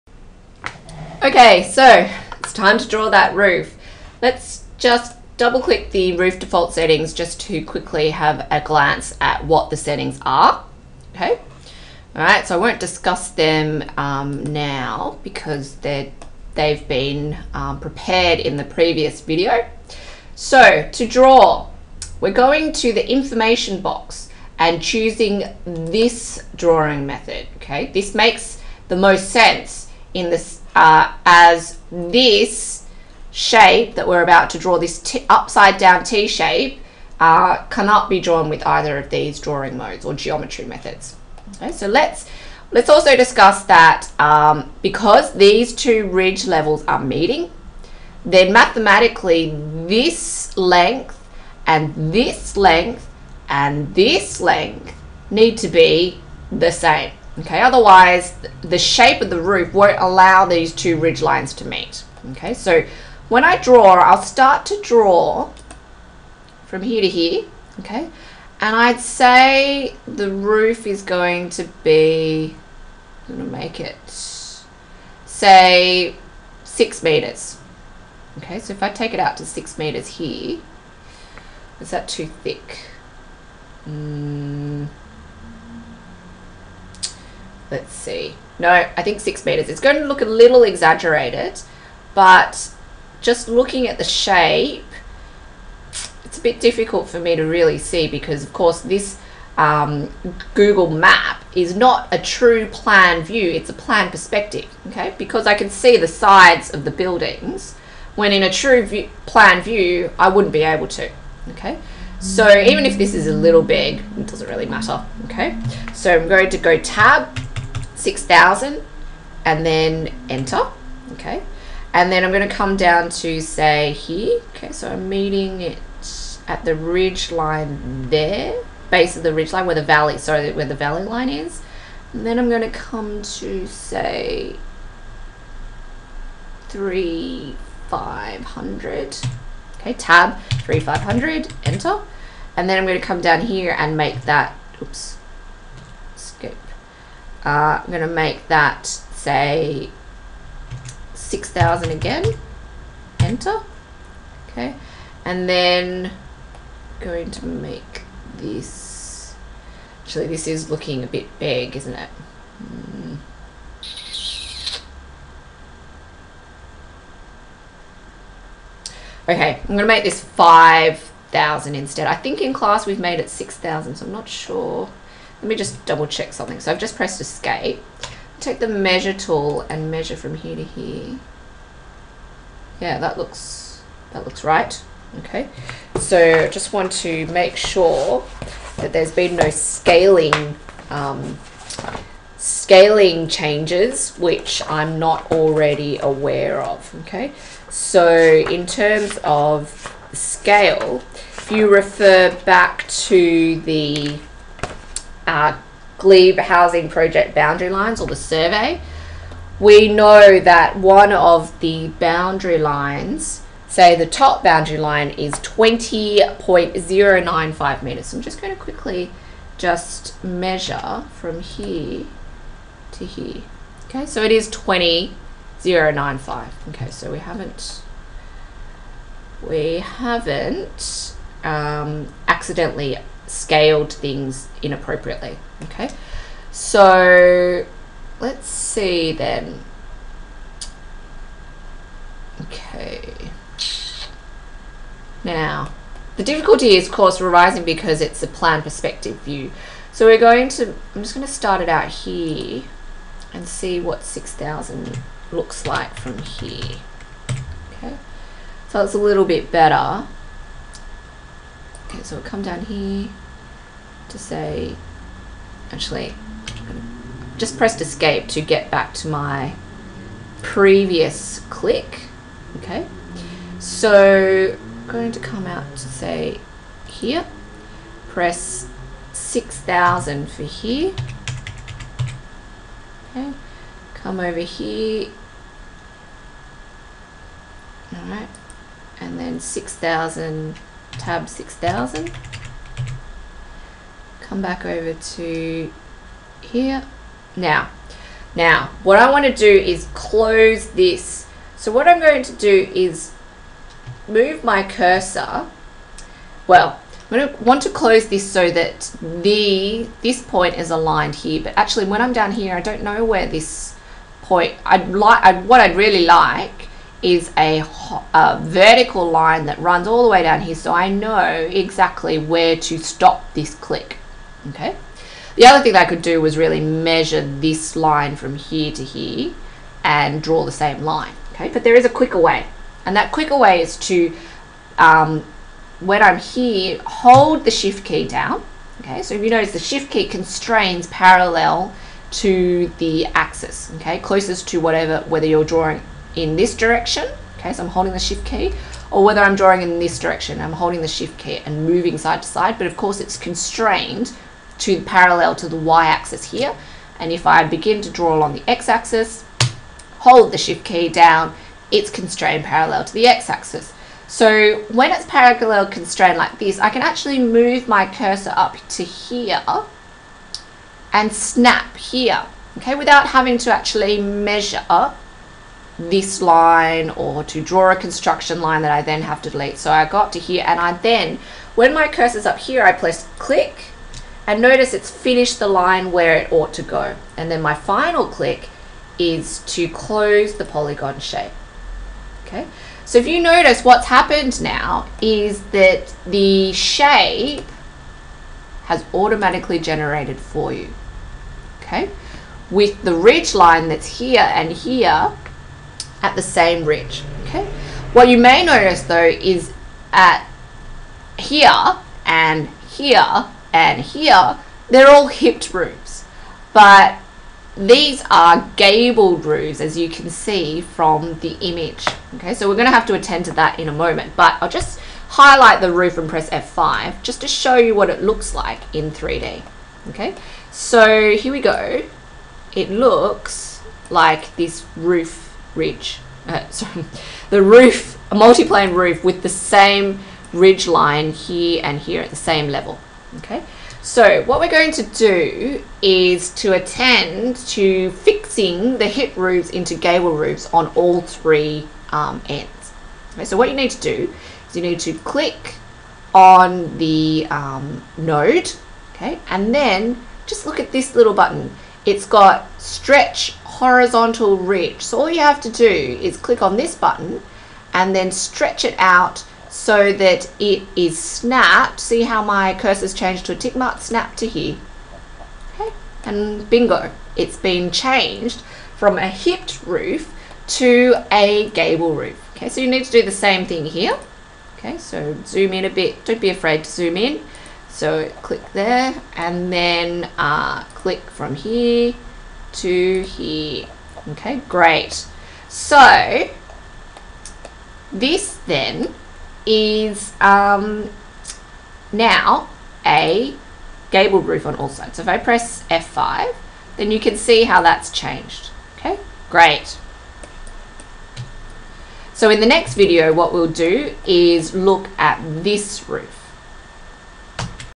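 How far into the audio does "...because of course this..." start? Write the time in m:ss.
1:38.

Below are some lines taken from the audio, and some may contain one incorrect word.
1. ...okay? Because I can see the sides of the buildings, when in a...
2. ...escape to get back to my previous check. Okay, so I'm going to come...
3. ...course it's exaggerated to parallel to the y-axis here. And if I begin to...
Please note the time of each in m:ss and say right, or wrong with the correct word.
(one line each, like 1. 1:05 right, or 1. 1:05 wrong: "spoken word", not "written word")
1. 1:44 right
2. 4:27 wrong: "click", not "check"
3. 5:52 wrong: "constrained", not "exaggerated".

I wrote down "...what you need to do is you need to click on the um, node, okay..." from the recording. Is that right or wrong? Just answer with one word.
right.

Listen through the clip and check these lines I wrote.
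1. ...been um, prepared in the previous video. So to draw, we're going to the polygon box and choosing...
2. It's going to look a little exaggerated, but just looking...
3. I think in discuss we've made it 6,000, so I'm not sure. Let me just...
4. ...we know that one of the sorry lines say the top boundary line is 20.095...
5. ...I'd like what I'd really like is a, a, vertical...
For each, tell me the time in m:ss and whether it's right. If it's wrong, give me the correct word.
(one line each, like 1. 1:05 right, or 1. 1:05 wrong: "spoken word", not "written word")
1. 0:16 wrong: "information", not "polygon"
2. 1:29 right
3. 2:52 wrong: "class", not "discuss"
4. 3:29 wrong: "boundary", not "sorry"
5. 5:14 right.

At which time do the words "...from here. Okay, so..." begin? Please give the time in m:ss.
4:15.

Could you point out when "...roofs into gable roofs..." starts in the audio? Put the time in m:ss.
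7:29.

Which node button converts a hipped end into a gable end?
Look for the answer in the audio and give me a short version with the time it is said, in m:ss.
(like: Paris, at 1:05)
stretch horizontal reach, at 7:42.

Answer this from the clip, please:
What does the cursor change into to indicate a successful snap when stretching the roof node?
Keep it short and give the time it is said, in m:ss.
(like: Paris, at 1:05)
tick mark, at 7:53.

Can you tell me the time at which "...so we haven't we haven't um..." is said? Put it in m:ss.
3:46.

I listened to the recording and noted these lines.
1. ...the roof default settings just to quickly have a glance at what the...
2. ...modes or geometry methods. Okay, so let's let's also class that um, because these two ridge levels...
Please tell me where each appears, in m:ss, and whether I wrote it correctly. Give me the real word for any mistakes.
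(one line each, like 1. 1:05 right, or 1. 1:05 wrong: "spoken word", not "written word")
1. 0:05 right
2. 0:39 wrong: "discuss", not "class".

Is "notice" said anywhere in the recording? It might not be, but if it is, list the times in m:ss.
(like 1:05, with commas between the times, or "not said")
5:39, 6:24, 6:33, 6:48.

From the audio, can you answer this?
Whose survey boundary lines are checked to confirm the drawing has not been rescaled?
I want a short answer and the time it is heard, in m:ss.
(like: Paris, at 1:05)
glebe, at 3:25.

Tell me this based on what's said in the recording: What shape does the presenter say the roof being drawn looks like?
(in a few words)
upside down T.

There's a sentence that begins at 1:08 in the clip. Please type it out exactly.
And I'd say the roof is going to be, I'm gonna make it, say six meters.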